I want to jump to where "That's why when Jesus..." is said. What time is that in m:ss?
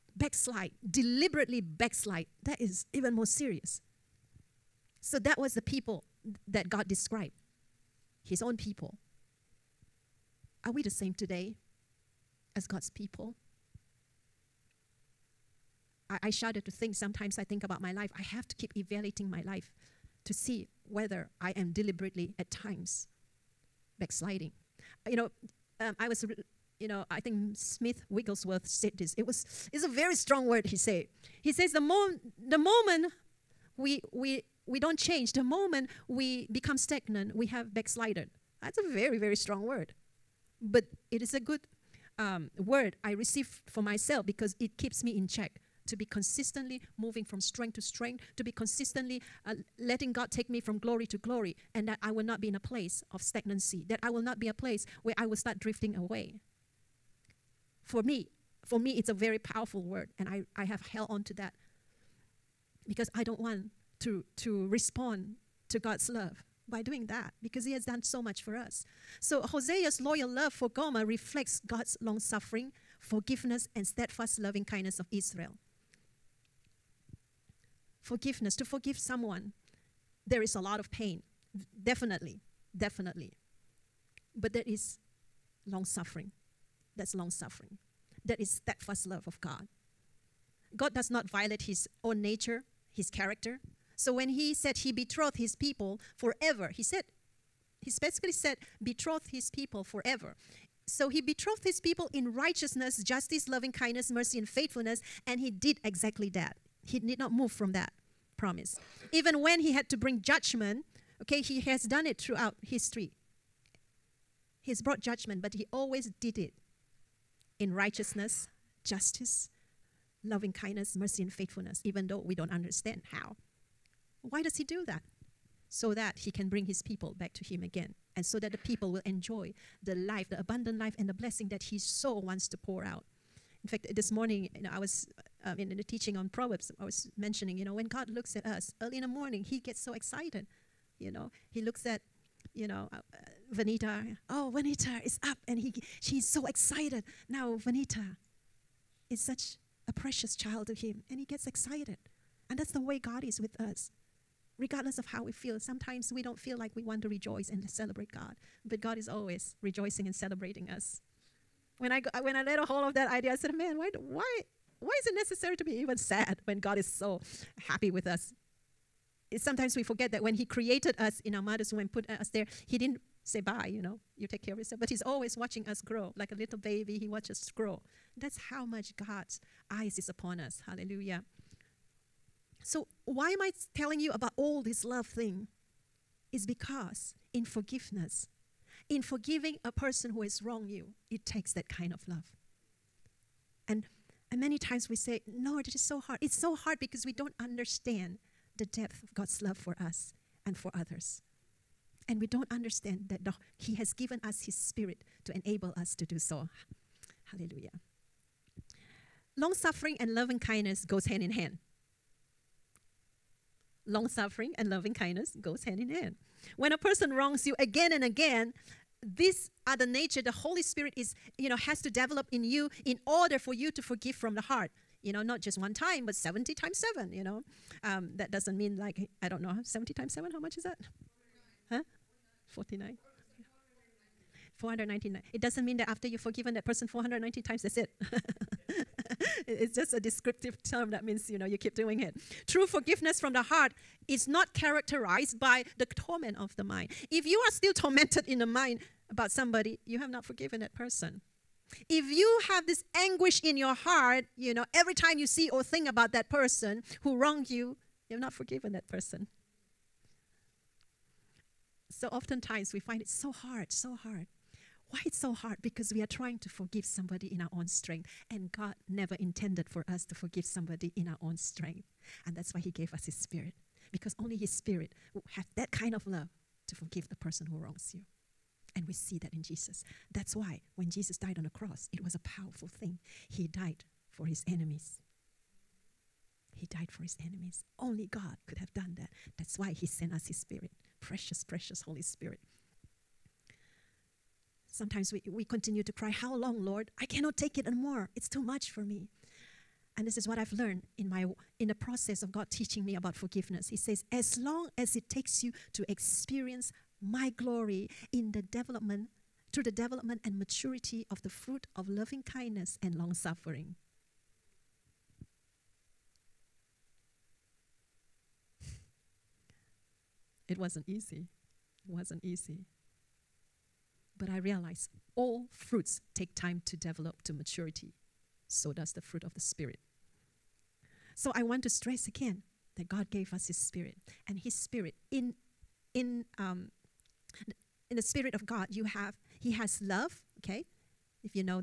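4:40.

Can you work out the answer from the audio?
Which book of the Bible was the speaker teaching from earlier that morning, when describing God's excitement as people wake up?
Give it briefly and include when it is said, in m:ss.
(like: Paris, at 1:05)
Proverbs, at 2:16.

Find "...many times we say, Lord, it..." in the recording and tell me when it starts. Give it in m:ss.
3:14.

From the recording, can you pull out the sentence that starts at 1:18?
Forgiveness, to forgive someone, there is a lot of pain.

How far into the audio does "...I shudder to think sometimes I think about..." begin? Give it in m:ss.
0:16.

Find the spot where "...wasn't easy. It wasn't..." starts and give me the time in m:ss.
5:20.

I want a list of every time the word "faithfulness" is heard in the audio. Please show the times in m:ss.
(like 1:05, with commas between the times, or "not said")
1:44, 2:01.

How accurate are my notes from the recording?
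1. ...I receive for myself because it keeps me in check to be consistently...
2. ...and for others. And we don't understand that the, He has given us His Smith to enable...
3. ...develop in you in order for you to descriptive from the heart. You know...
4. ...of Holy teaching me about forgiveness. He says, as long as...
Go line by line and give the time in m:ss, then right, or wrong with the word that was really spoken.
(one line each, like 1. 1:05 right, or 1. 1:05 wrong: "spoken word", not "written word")
1. 0:43 right
2. 3:20 wrong: "Spirit", not "Smith"
3. 3:41 wrong: "forgive", not "descriptive"
4. 5:02 wrong: "God", not "Holy".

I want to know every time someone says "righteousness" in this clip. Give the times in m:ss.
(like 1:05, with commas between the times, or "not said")
1:42, 1:57.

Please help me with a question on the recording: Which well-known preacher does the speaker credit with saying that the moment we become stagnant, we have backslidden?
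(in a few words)
Smith Wigglesworth.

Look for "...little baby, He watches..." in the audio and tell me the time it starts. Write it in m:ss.
2:56.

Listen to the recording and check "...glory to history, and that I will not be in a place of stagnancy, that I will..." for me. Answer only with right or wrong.
wrong.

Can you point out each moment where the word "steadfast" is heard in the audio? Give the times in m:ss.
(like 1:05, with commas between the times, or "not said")
1:13, 1:28.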